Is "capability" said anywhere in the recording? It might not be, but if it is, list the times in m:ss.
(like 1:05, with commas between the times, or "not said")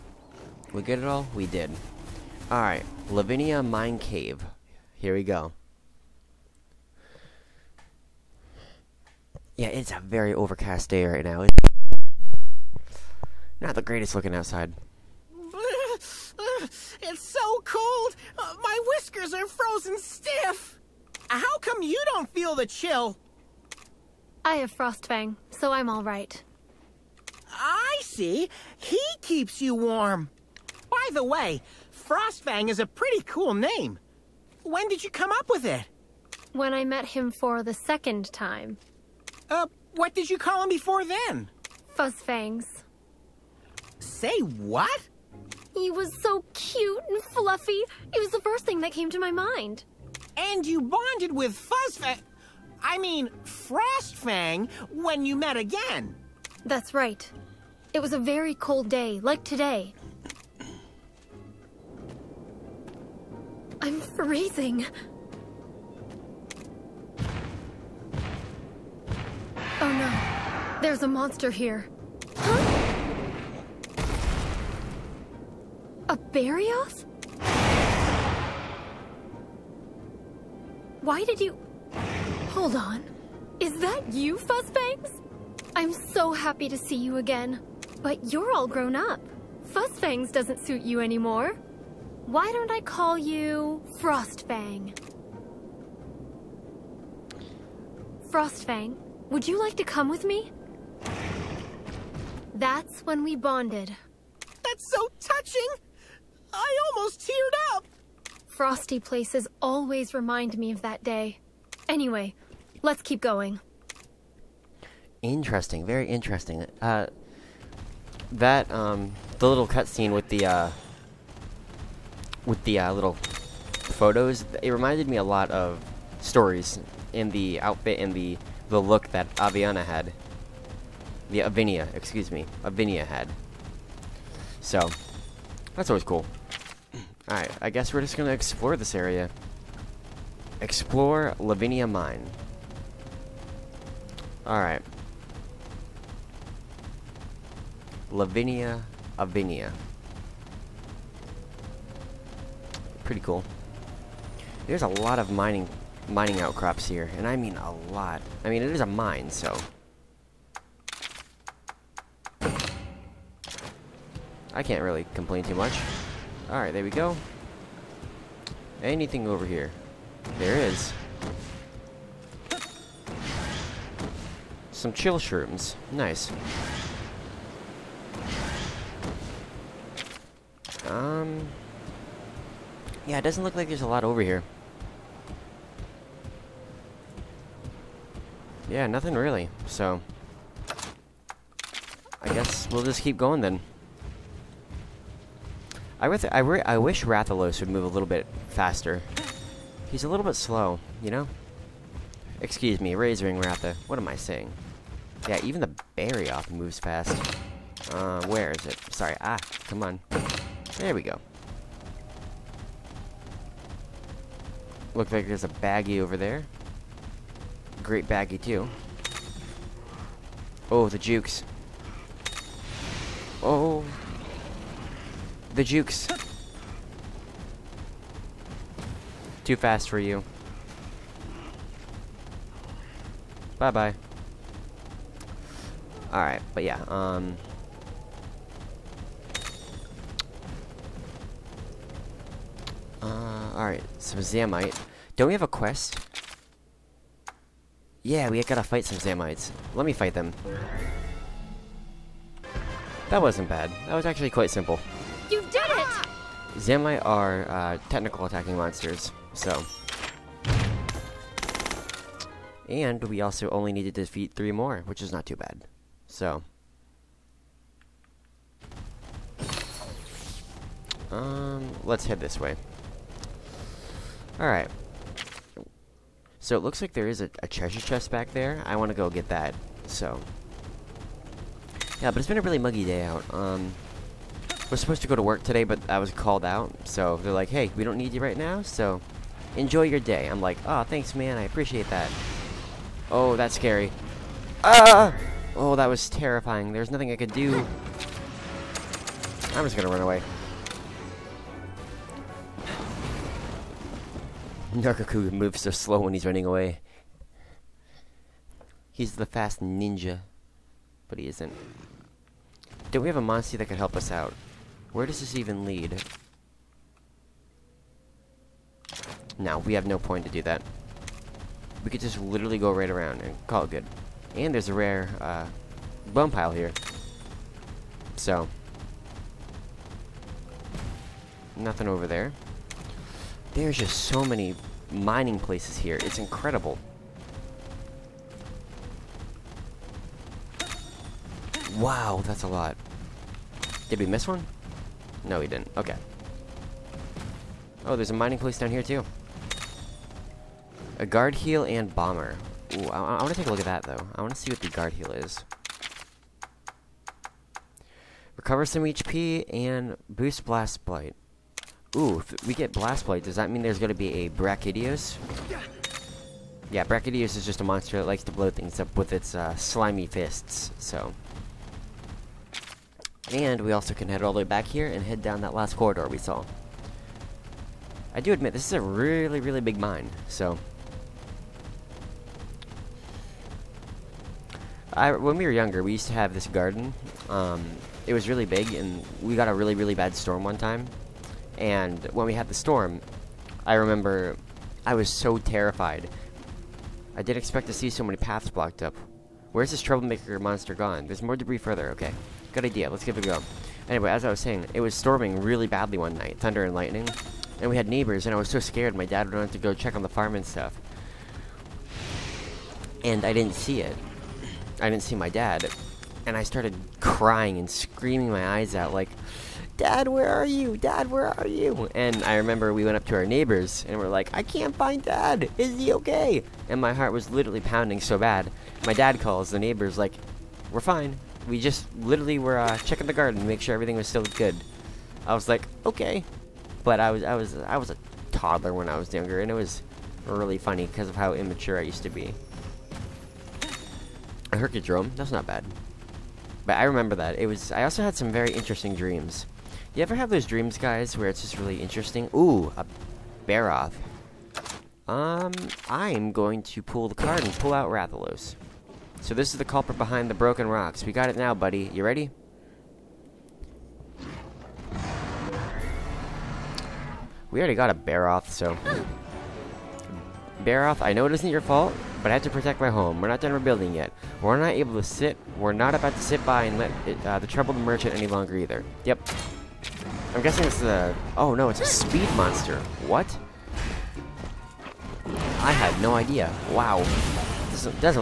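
not said.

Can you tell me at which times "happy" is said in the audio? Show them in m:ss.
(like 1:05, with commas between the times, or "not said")
1:26.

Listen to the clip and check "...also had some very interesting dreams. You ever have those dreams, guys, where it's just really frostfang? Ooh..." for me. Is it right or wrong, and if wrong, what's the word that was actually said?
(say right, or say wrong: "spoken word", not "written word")
wrong: "interesting", not "frostfang".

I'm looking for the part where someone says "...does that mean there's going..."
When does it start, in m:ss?
6:03.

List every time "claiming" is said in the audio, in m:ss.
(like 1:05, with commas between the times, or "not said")
not said.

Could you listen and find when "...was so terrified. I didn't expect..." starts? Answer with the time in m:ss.
6:34.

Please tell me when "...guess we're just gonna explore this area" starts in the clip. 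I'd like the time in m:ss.
2:17.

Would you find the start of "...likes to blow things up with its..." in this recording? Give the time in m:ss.
6:08.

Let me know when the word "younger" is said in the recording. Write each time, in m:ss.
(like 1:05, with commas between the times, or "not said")
6:25, 7:19.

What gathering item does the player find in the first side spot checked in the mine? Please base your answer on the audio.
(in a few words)
Chill shrooms.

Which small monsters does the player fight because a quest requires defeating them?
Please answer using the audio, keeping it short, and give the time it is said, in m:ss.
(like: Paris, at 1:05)
Zamite, at 4:04.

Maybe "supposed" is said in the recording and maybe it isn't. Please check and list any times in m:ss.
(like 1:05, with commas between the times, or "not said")
4:44.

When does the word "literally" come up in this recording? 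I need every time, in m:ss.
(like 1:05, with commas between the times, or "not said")
5:22, 7:07, 7:11.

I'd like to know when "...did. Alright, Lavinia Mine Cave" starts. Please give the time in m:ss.
0:01.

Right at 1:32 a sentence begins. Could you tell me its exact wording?
Why don't I call you Frostfang?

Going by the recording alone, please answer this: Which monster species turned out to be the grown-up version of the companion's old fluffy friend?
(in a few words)
Barioth.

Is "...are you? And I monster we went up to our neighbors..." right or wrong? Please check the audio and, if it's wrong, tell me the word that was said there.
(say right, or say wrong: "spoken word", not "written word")
wrong: "remember", not "monster".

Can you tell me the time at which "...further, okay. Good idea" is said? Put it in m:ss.
6:41.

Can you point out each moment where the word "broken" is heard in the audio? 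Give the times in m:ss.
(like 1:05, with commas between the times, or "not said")
7:40.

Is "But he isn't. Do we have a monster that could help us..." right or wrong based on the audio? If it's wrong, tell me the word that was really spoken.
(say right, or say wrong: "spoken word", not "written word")
right.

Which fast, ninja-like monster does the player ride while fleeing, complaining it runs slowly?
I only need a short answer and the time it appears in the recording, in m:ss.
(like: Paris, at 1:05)
Nargacuga, at 5:04.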